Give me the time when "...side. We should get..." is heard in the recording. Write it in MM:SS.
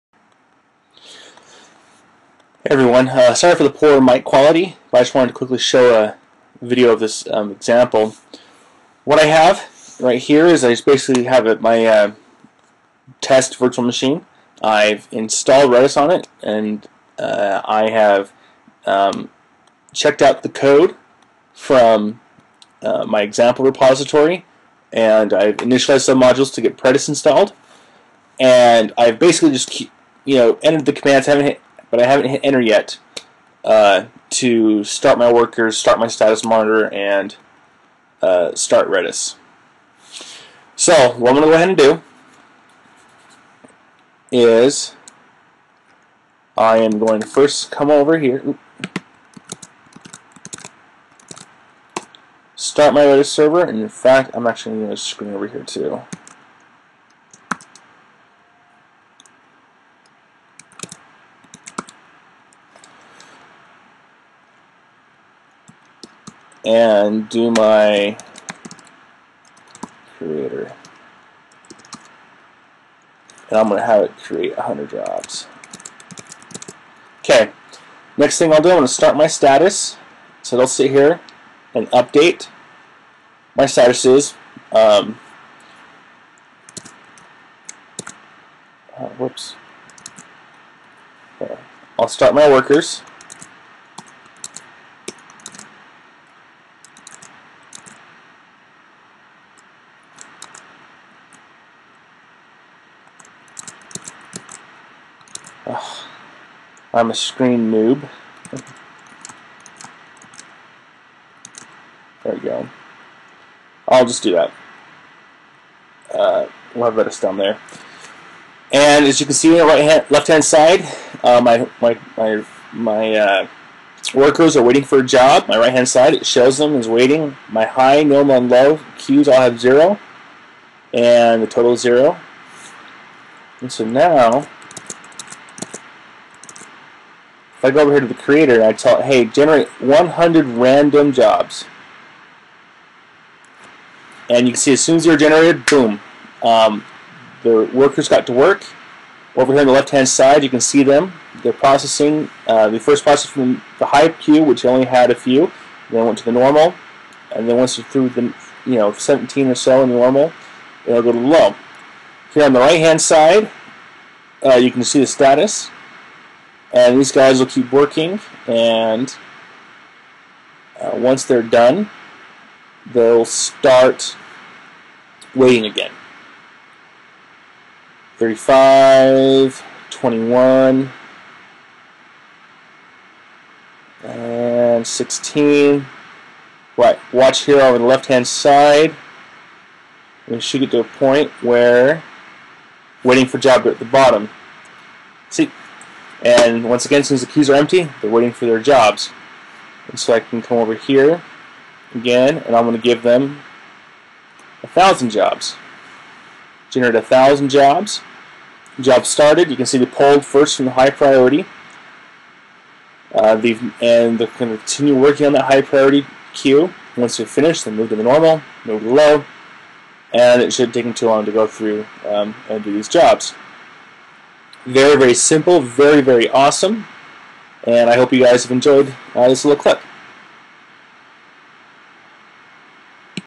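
03:08.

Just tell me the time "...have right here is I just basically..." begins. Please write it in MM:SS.
00:09.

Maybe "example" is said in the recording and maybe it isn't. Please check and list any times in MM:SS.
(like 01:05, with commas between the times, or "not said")
00:07, 00:23.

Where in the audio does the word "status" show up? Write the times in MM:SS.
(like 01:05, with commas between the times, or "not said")
00:36, 01:19, 01:23, 02:45.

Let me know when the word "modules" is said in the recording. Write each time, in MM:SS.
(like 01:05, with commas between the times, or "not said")
00:26.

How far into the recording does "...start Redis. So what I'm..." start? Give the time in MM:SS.
00:38.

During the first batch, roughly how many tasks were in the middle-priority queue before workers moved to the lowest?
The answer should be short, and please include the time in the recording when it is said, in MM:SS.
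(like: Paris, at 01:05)
17, at 02:38.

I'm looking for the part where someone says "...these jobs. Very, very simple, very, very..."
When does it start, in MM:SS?
03:42.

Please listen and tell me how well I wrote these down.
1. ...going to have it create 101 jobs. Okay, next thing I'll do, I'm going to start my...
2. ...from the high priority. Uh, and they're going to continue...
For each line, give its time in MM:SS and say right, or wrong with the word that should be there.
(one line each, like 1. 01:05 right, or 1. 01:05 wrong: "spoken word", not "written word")
1. 01:13 wrong: "100", not "101"
2. 03:30 right.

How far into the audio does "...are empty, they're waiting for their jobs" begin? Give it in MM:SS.
03:17.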